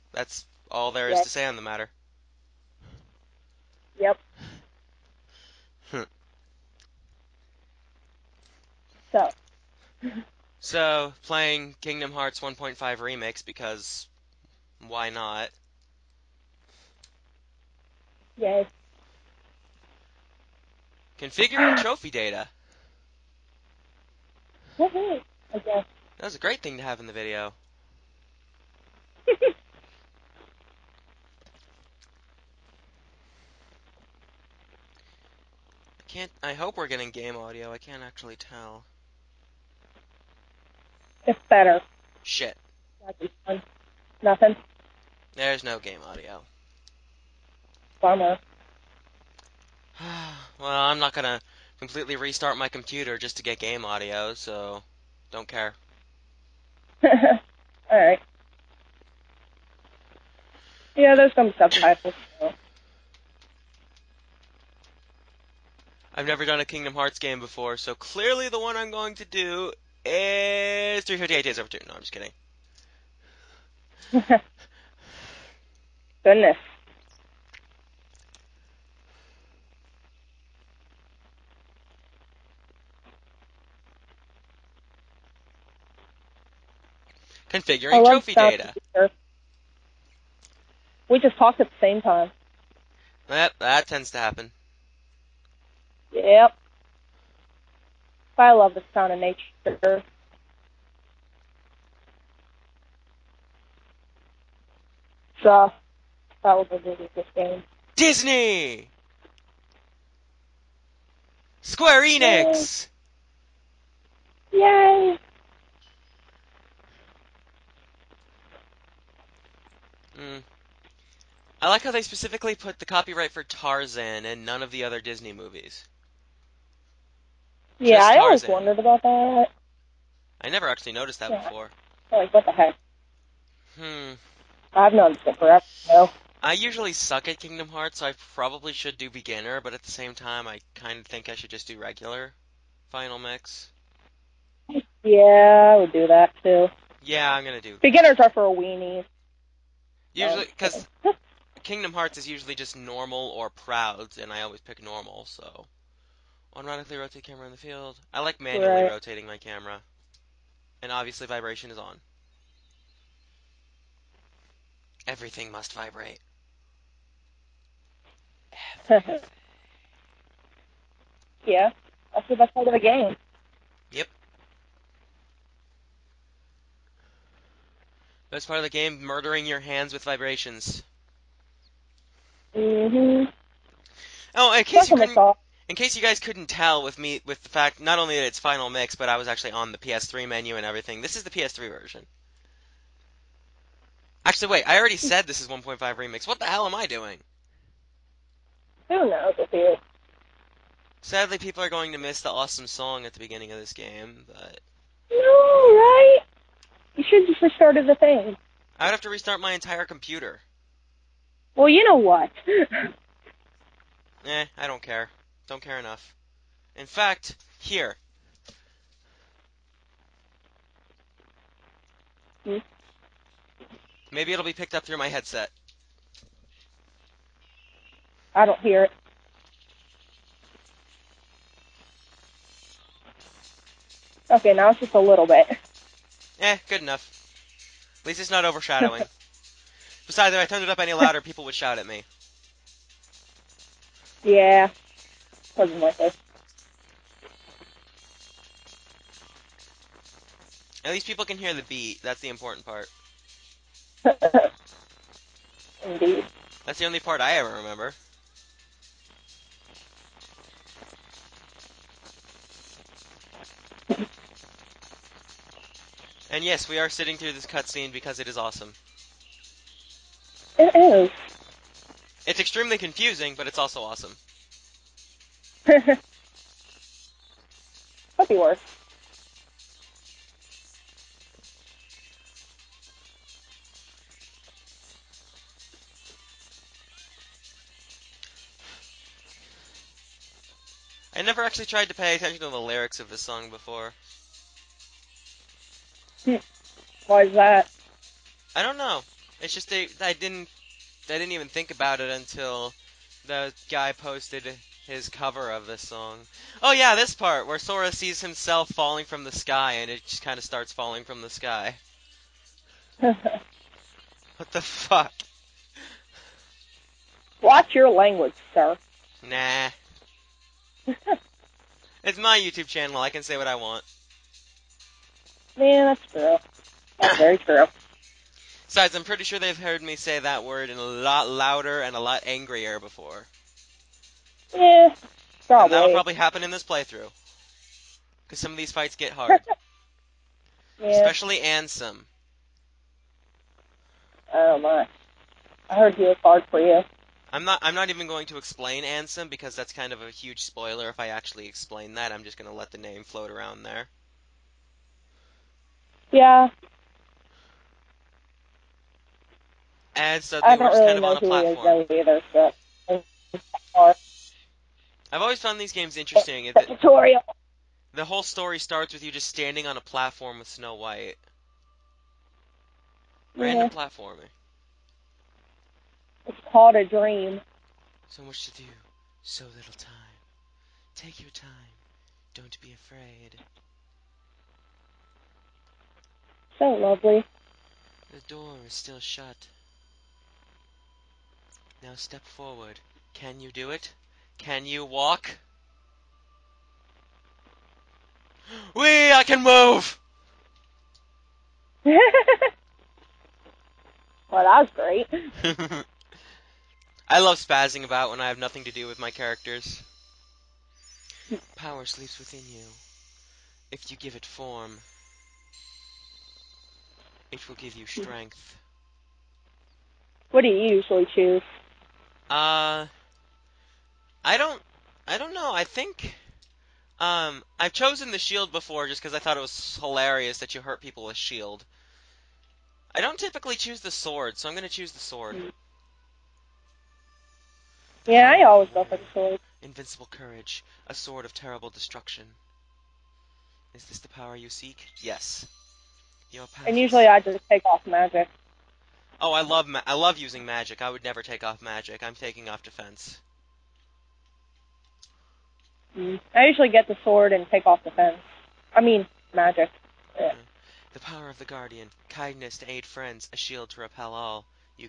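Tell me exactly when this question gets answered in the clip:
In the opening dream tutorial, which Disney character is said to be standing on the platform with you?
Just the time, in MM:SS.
06:10.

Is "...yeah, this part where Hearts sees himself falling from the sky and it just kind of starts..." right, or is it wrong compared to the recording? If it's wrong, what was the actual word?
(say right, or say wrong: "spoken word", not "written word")
wrong: "Sora", not "Hearts".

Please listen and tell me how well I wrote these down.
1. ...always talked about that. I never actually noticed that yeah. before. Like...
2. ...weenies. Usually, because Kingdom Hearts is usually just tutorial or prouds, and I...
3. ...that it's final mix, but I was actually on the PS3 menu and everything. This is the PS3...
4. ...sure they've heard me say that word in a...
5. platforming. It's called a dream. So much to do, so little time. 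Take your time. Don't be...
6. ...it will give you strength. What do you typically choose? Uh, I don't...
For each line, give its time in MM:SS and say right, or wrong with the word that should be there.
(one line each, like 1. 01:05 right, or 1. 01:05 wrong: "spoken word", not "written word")
1. 02:08 wrong: "wondered", not "talked"
2. 02:28 wrong: "normal", not "tutorial"
3. 03:08 right
4. 05:29 right
5. 06:13 right
6. 06:57 wrong: "usually", not "typically".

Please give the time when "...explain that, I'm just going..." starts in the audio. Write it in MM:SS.
05:51.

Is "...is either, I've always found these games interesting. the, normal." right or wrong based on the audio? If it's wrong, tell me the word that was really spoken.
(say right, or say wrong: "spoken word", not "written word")
wrong: "tutorial", not "normal".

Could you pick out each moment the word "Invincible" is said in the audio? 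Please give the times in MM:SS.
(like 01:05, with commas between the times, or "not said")
07:19.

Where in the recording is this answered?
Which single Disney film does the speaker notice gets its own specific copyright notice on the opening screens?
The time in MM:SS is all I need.
02:03.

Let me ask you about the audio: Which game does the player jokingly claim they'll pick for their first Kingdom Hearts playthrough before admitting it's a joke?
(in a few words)
358 Days.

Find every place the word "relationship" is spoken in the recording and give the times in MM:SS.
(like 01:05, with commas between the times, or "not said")
not said.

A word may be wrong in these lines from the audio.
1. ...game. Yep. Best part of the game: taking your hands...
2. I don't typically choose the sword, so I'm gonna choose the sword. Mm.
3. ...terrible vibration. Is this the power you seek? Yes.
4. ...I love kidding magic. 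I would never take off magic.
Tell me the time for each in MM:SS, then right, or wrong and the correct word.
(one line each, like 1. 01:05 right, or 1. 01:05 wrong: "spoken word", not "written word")
1. 02:52 wrong: "murdering", not "taking"
2. 07:12 right
3. 07:21 wrong: "destruction", not "vibration"
4. 07:29 wrong: "using", not "kidding".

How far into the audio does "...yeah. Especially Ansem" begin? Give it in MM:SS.
05:40.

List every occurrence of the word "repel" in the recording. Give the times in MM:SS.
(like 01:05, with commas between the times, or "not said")
07:43.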